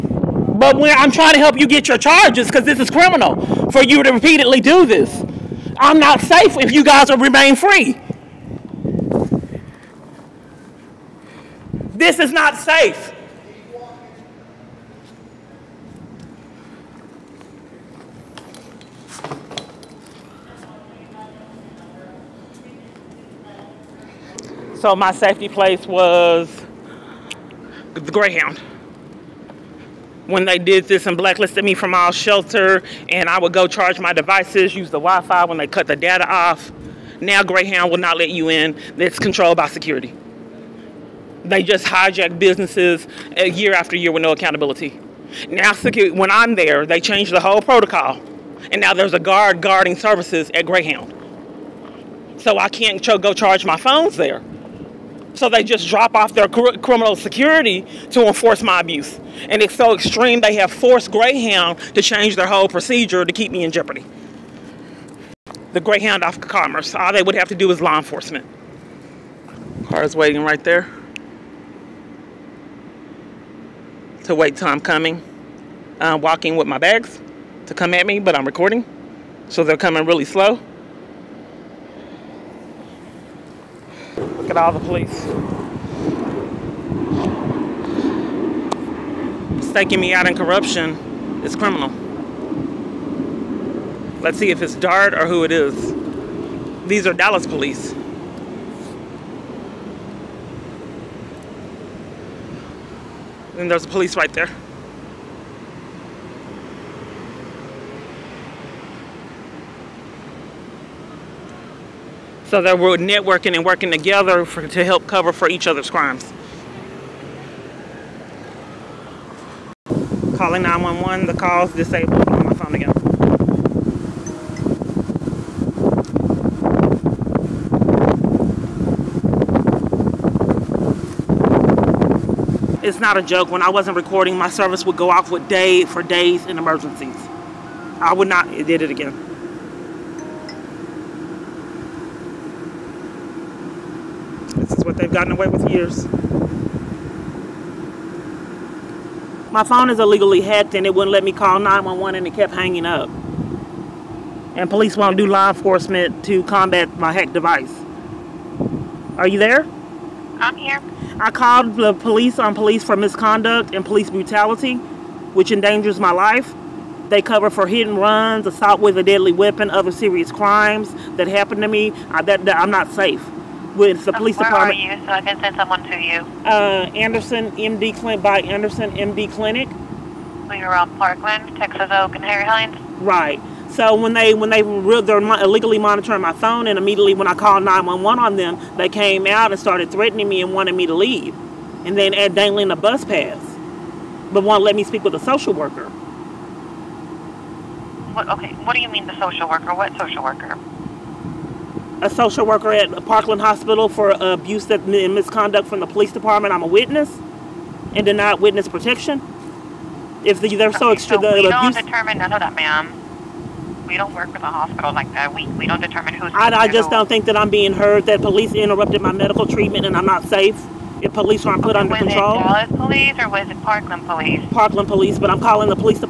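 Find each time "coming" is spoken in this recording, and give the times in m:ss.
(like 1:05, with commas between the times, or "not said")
1:14, 1:19.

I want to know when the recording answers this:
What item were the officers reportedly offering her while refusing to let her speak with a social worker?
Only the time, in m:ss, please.
3:12.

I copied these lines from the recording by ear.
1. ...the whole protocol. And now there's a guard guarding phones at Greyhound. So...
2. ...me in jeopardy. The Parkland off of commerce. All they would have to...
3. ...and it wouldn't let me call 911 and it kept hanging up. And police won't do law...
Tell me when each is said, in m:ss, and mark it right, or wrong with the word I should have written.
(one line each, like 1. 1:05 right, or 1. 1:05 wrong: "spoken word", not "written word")
1. 0:47 wrong: "services", not "phones"
2. 1:03 wrong: "Greyhound", not "Parkland"
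3. 2:30 right.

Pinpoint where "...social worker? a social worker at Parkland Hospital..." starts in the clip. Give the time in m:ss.
3:19.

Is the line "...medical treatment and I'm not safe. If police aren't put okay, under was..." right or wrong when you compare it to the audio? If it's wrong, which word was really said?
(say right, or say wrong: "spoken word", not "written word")
right.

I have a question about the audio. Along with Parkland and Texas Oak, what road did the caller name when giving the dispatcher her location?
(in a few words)
Harry Hines.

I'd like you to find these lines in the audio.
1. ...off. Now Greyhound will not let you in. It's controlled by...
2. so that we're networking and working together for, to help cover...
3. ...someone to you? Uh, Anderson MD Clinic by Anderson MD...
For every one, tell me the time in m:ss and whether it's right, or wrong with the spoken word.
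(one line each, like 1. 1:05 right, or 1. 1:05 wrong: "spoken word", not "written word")
1. 0:36 right
2. 1:52 right
3. 2:55 right.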